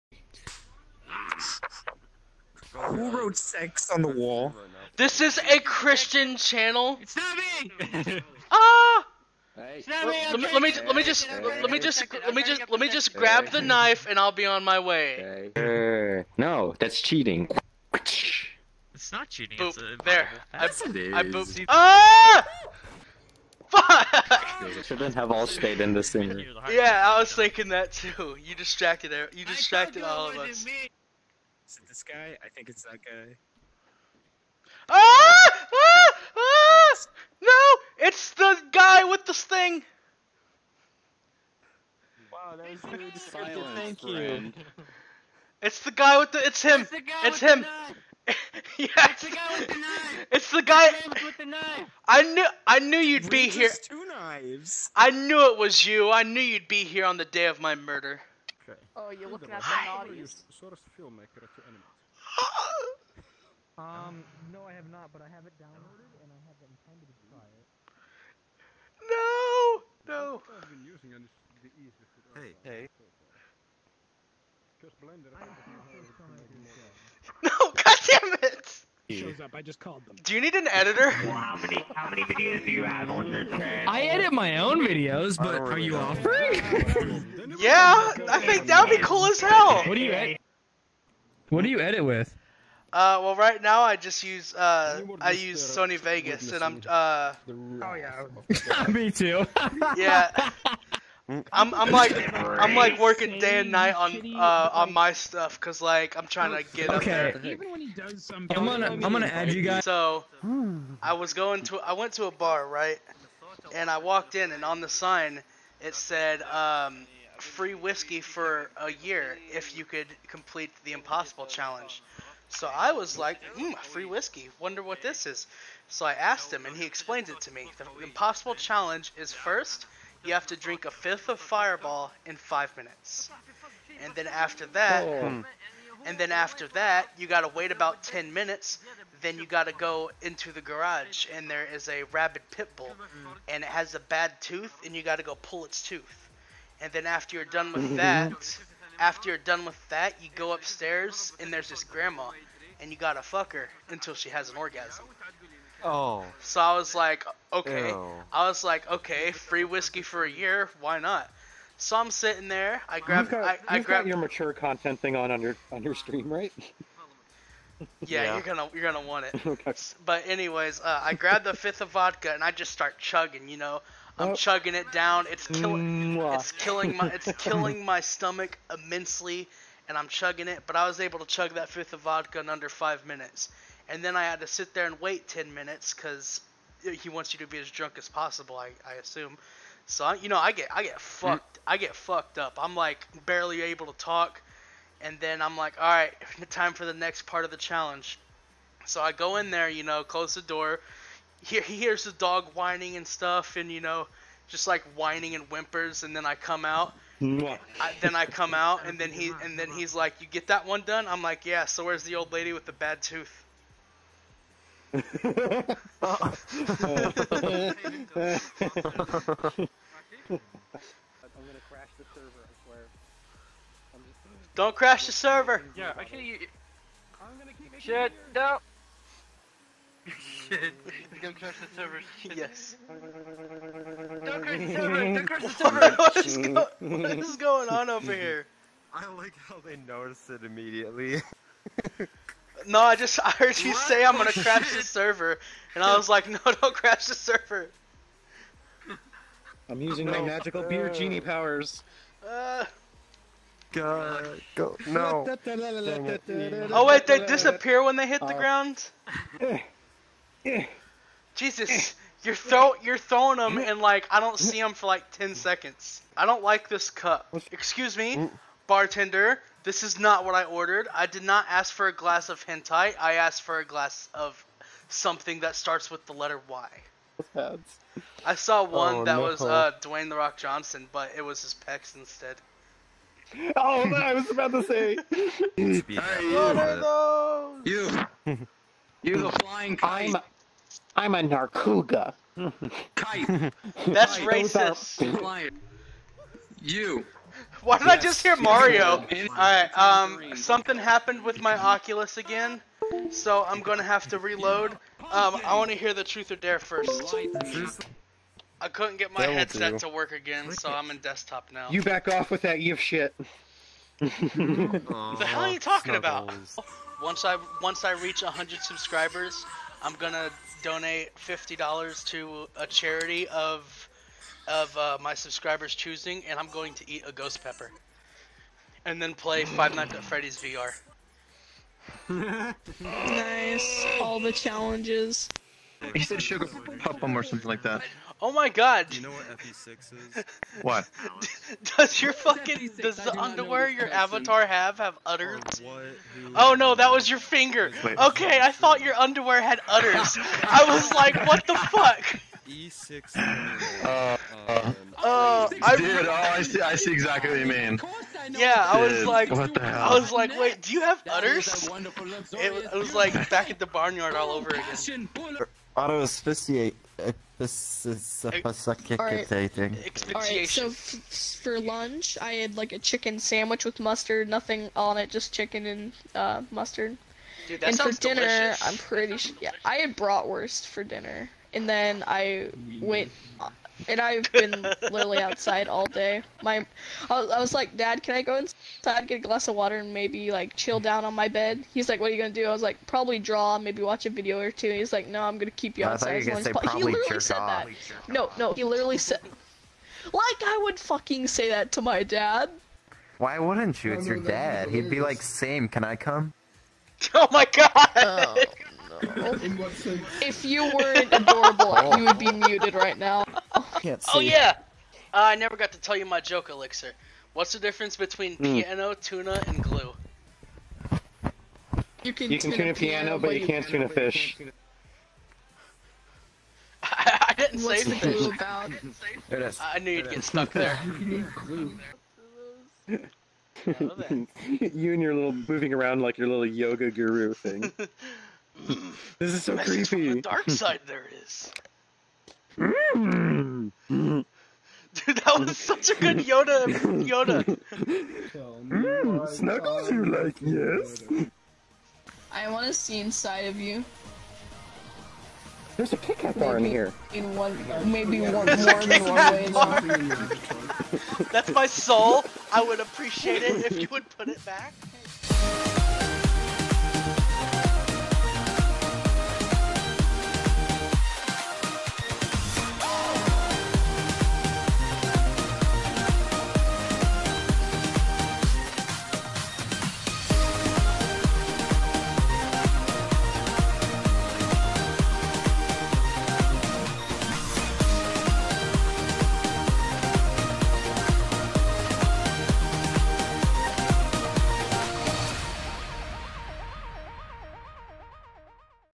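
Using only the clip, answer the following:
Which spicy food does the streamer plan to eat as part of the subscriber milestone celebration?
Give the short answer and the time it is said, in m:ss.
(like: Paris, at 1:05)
ghost pepper, at 5:27.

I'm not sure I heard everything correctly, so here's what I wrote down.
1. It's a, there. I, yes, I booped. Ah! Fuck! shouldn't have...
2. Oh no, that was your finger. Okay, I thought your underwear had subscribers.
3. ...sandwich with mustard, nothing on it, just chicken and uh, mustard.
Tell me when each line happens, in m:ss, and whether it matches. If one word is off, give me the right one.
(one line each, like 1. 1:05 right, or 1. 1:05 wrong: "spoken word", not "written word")
1. 0:19 right
2. 5:46 wrong: "udders", not "subscribers"
3. 6:13 right.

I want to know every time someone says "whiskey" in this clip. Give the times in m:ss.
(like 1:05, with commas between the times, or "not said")
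1:57, 2:04, 2:39.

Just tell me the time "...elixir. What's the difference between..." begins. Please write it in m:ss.
6:56.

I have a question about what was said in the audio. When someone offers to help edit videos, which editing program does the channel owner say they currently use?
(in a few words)
Sony Vegas.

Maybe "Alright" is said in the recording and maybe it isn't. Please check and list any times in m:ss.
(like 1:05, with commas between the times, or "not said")
4:59, 6:06.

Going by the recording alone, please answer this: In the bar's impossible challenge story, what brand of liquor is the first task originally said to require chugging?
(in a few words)
Fireball.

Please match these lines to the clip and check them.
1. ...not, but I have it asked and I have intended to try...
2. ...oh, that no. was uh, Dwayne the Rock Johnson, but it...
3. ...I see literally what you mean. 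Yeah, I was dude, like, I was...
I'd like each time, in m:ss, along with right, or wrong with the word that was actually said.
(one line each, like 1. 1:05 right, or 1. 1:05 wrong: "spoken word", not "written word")
1. 1:04 wrong: "downloaded", not "asked"
2. 4:38 right
3. 5:56 wrong: "exactly", not "literally".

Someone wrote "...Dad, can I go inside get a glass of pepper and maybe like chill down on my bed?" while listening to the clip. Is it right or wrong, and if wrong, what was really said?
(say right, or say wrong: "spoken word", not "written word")
wrong: "water", not "pepper".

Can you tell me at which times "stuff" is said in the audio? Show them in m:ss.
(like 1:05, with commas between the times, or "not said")
1:45, 3:23.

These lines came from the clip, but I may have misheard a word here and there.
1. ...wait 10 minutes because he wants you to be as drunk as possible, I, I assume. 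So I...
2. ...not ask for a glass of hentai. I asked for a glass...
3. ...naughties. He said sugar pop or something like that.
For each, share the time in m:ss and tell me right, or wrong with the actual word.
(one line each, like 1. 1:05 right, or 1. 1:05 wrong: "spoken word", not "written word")
1. 3:05 right
2. 4:31 right
3. 5:34 wrong: "challenges", not "naughties".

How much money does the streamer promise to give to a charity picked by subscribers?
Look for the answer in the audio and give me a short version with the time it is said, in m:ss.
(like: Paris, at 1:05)
$50, at 5:21.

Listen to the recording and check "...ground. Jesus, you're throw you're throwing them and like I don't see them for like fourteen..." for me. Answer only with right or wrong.
wrong.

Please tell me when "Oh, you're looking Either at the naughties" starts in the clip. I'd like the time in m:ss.
0:58.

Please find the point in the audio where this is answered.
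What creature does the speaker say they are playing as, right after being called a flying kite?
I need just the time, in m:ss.
4:51.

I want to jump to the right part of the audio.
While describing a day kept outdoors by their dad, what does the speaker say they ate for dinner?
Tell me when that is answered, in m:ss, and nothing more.
6:19.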